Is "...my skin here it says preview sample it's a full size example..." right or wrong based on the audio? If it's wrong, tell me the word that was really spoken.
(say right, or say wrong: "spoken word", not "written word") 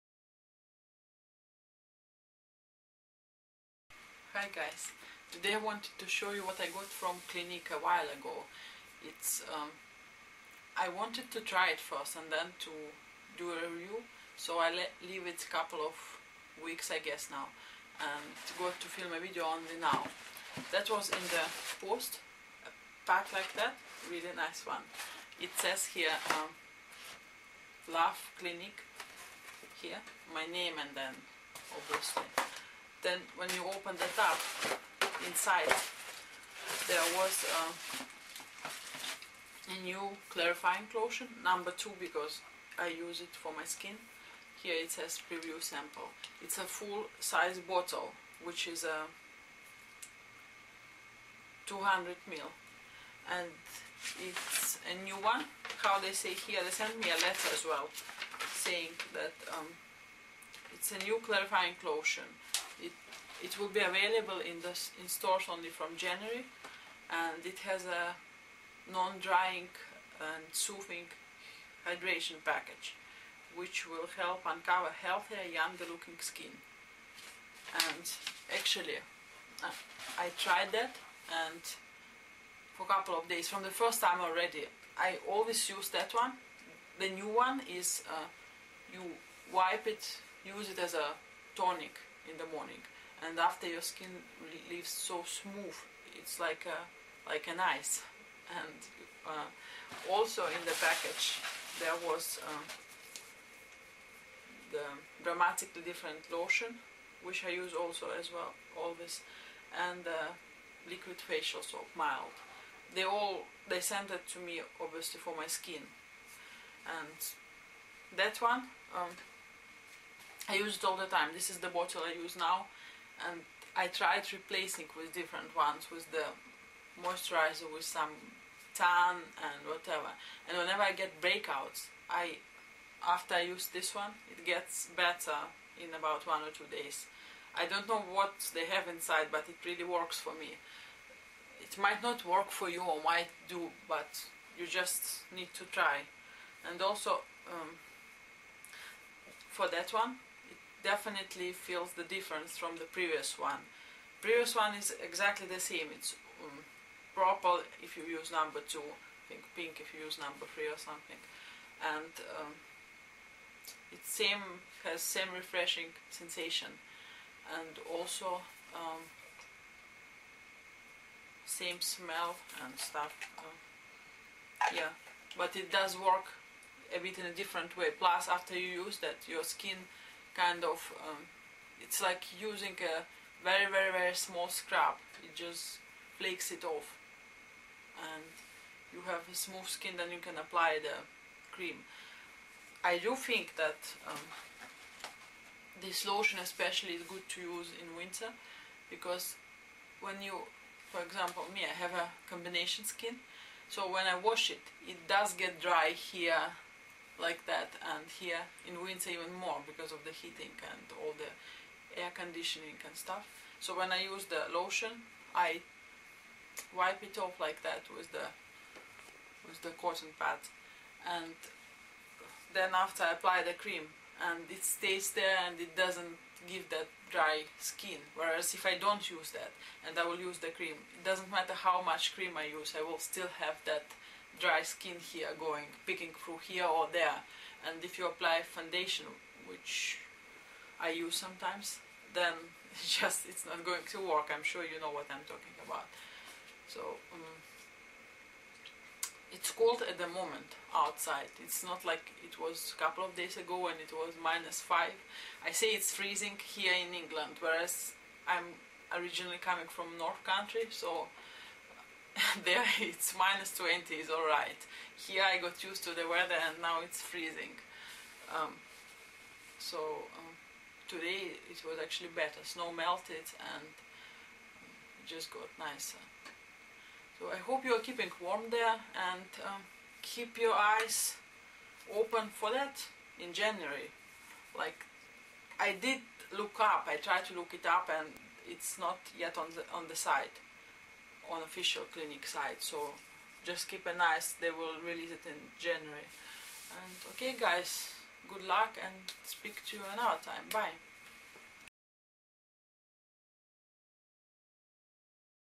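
wrong: "bottle", not "example".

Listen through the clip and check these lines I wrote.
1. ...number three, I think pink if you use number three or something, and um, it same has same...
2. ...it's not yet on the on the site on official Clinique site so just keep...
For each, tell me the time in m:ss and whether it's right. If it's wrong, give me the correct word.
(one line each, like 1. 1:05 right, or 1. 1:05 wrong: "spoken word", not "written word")
1. 2:38 wrong: "two", not "three"
2. 4:48 right.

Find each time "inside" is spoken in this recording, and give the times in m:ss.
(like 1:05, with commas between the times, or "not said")
0:35, 2:18.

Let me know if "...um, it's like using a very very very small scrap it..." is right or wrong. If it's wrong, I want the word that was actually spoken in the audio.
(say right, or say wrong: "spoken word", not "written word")
right.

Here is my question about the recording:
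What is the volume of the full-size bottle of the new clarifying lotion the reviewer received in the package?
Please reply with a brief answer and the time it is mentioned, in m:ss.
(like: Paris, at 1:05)
200 ml, at 0:51.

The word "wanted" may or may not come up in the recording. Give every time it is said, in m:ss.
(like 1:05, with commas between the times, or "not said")
0:05, 0:10.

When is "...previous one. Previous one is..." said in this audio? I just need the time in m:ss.
2:32.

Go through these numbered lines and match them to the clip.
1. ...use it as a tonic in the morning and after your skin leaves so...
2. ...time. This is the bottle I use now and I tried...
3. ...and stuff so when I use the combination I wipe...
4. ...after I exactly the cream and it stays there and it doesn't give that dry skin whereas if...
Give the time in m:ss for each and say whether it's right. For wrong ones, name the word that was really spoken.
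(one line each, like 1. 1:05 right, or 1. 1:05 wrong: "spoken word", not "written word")
1. 1:30 right
2. 2:01 right
3. 3:32 wrong: "lotion", not "combination"
4. 3:42 wrong: "apply", not "exactly".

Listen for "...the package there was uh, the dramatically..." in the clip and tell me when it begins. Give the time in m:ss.
1:40.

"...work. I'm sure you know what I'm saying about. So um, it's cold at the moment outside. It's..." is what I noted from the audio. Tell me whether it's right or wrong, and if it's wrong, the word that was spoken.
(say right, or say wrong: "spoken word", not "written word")
wrong: "talking", not "saying".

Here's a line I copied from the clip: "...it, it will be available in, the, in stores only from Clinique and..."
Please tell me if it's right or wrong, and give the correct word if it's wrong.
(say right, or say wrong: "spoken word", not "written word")
wrong: "January", not "Clinique".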